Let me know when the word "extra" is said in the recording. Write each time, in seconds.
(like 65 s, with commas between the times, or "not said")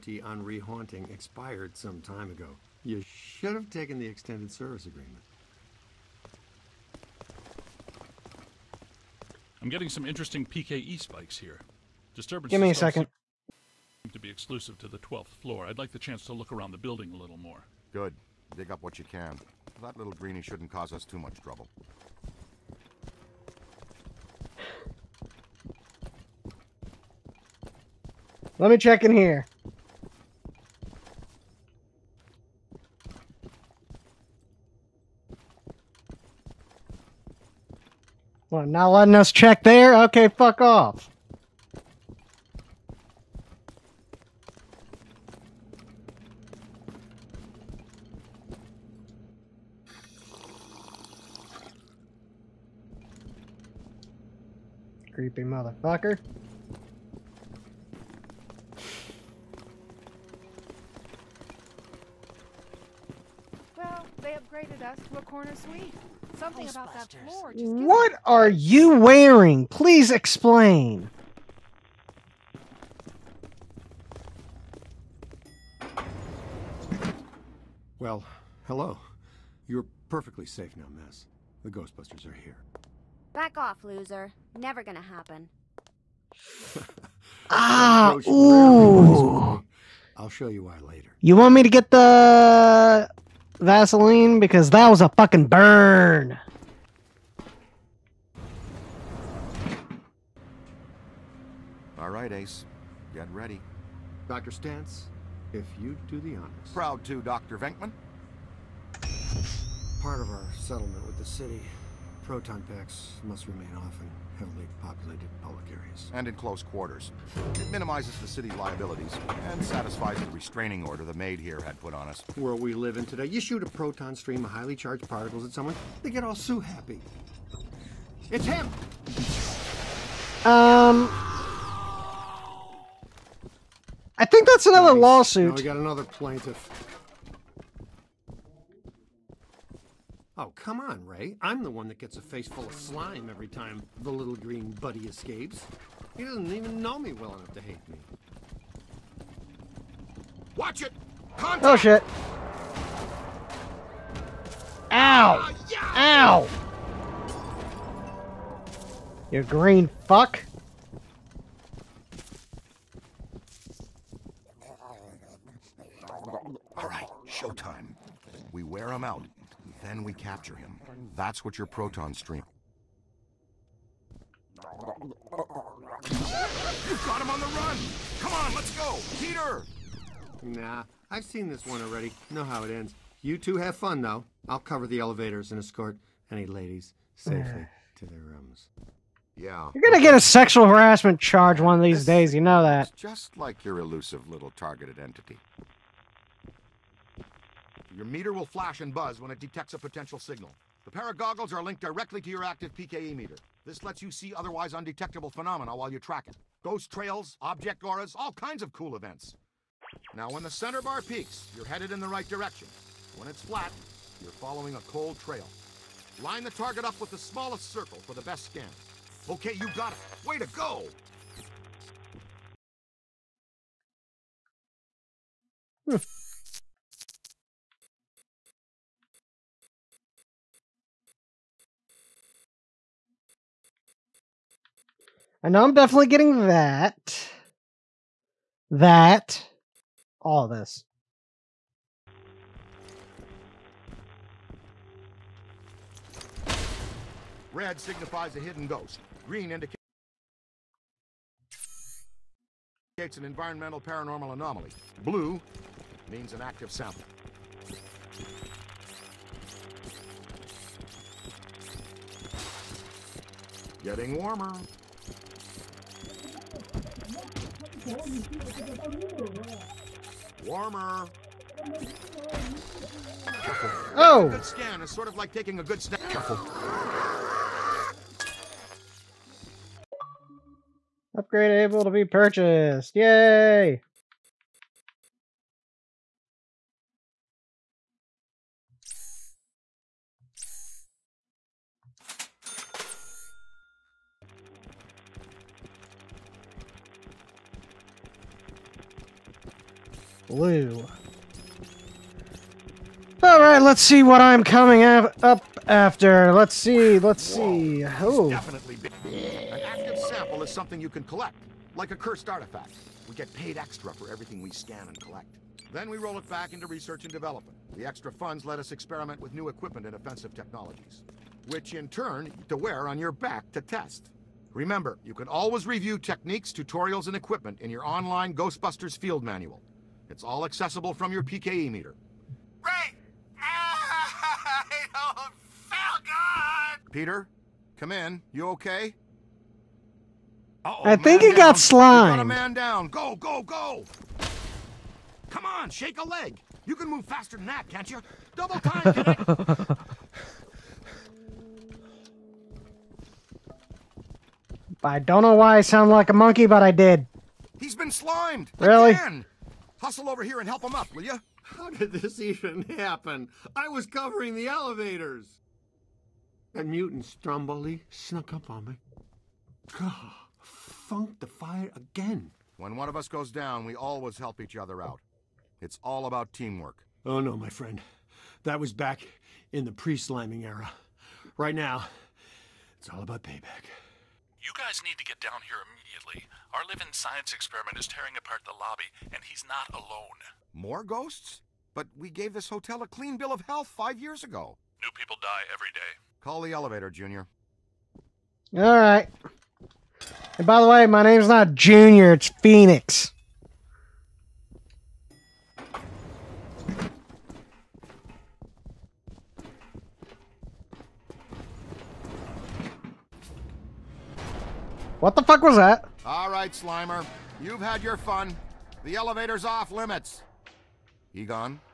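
313 s, 317 s.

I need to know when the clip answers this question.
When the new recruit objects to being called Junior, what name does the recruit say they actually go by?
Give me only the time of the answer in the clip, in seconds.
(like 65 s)
402 s.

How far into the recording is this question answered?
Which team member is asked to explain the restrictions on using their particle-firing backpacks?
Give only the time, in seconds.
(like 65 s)
104 s.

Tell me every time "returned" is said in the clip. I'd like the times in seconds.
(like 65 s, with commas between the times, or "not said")
not said.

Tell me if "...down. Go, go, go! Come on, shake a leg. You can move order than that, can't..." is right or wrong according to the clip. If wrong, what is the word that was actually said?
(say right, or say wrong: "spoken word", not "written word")
wrong: "faster", not "order".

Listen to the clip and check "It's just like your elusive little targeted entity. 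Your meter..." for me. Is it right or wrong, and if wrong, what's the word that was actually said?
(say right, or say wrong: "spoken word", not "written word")
right.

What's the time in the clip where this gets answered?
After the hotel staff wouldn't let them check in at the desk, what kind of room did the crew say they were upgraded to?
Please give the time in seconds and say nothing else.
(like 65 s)
65 s.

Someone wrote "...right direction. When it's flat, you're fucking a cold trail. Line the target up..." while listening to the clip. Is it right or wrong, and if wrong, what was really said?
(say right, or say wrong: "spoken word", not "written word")
wrong: "following", not "fucking".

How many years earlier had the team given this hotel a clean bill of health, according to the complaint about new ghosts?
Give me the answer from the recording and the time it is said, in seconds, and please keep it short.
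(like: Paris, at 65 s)
5, at 393 s.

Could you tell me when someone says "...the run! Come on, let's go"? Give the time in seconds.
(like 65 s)
177 s.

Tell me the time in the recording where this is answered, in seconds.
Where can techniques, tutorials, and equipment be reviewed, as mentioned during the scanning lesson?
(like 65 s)
328 s.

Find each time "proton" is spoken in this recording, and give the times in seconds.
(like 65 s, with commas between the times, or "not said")
112 s, 123 s, 171 s.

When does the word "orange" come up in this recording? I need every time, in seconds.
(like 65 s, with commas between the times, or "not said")
not said.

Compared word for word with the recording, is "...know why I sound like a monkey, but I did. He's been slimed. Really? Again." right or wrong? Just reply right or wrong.
right.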